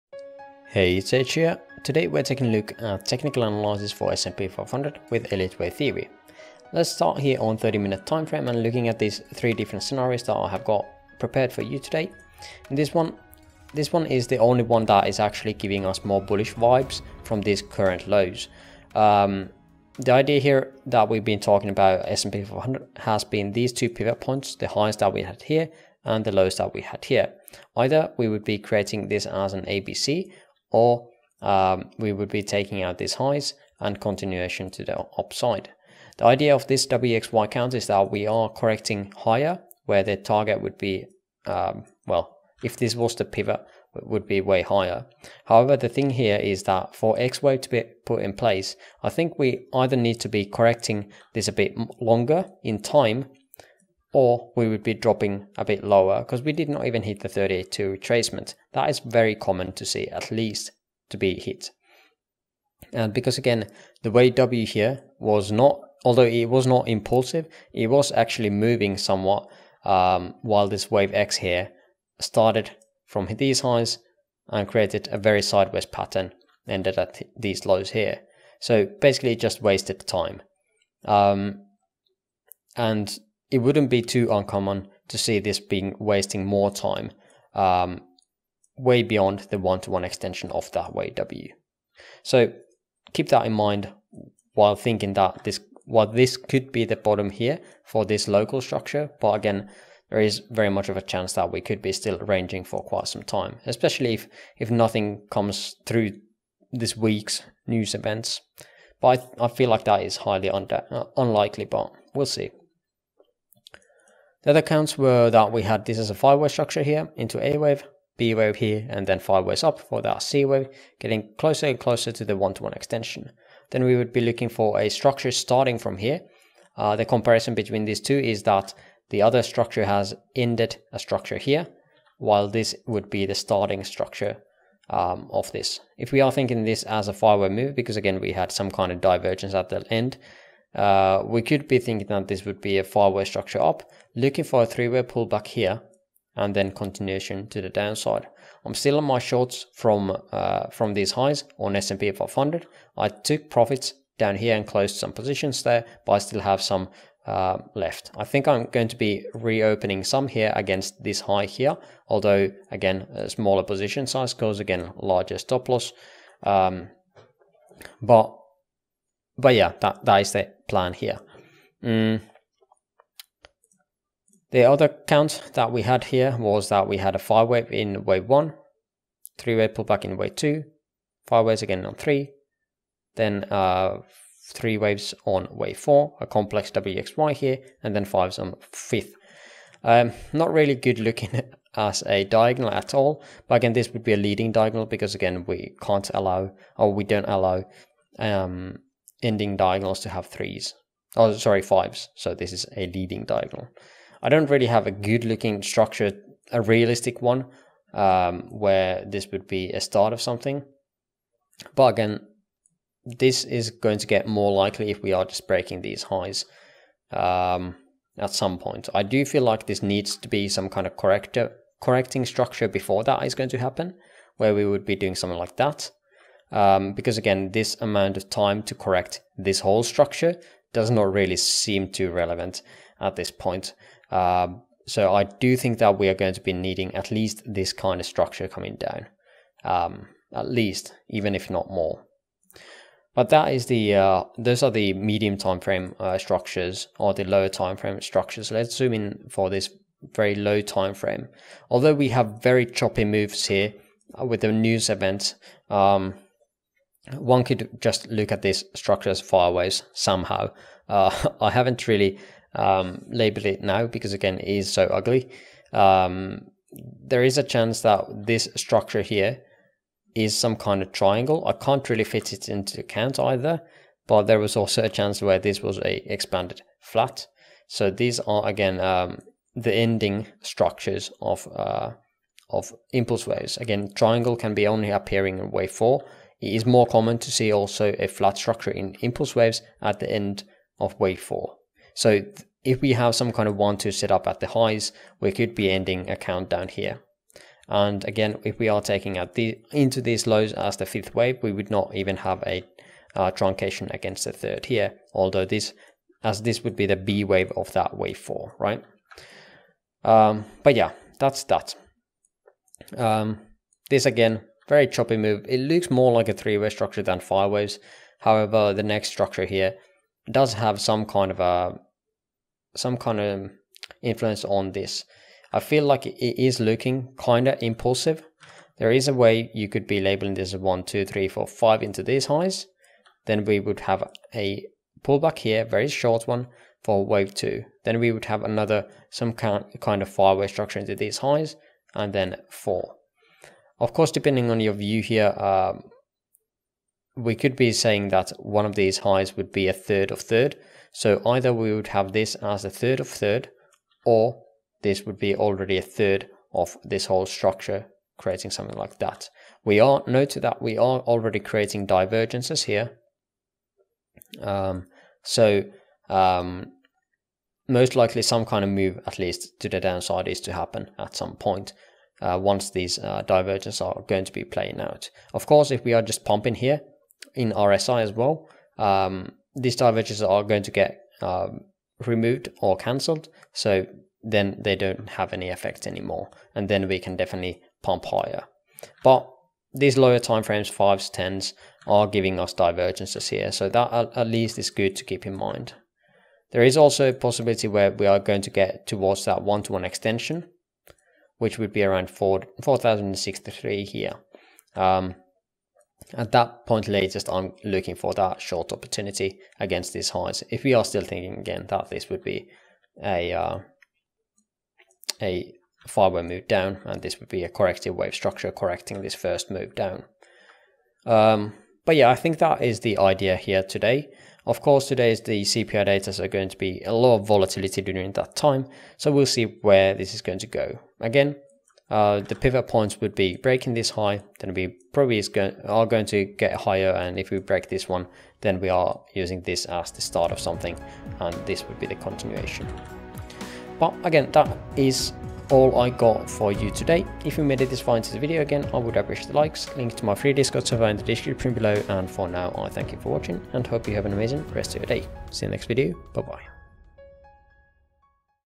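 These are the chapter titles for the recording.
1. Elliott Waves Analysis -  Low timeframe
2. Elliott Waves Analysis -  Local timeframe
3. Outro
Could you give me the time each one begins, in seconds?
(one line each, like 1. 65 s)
1. 11 s
2. 249 s
3. 443 s.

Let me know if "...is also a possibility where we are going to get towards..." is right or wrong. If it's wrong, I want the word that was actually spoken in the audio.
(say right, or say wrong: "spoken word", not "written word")
right.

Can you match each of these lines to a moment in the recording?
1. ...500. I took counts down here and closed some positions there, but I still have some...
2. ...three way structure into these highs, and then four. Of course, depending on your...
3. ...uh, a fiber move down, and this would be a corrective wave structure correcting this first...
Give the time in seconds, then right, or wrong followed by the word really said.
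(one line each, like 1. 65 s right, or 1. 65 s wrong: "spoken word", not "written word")
1. 152 s wrong: "profits", not "counts"
2. 340 s wrong: "five", not "three"
3. 413 s right.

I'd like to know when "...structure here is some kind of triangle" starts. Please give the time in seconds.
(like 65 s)
268 s.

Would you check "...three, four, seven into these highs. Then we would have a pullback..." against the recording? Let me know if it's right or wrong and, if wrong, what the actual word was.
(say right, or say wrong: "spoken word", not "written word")
wrong: "five", not "seven".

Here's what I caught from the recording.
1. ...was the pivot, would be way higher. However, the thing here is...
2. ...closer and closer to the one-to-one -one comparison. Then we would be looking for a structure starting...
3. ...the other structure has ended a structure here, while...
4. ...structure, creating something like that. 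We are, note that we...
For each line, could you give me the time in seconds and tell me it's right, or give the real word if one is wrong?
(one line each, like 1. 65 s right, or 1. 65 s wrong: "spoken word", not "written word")
1. 42 s right
2. 121 s wrong: "extension", not "comparison"
3. 129 s right
4. 357 s right.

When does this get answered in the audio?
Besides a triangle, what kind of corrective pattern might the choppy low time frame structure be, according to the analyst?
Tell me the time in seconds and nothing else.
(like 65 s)
276 s.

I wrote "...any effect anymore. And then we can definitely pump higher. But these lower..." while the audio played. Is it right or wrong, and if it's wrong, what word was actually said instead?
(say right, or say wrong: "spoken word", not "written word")
right.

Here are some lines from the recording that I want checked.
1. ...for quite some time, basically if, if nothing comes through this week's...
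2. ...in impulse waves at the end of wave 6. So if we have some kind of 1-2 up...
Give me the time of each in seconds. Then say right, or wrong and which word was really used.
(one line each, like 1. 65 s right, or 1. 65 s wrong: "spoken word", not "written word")
1. 102 s wrong: "especially", not "basically"
2. 288 s wrong: "4", not "6".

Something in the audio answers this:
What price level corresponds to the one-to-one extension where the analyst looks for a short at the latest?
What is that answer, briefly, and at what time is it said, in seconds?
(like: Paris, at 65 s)
4063, at 402 s.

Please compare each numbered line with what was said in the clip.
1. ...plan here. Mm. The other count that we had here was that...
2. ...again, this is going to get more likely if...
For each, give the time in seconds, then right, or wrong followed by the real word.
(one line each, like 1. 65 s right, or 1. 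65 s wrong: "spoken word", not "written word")
1. 170 s right
2. 211 s right.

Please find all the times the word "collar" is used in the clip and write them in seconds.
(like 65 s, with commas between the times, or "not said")
not said.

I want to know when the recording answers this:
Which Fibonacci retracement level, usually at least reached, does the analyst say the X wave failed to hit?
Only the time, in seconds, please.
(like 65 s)
57 s.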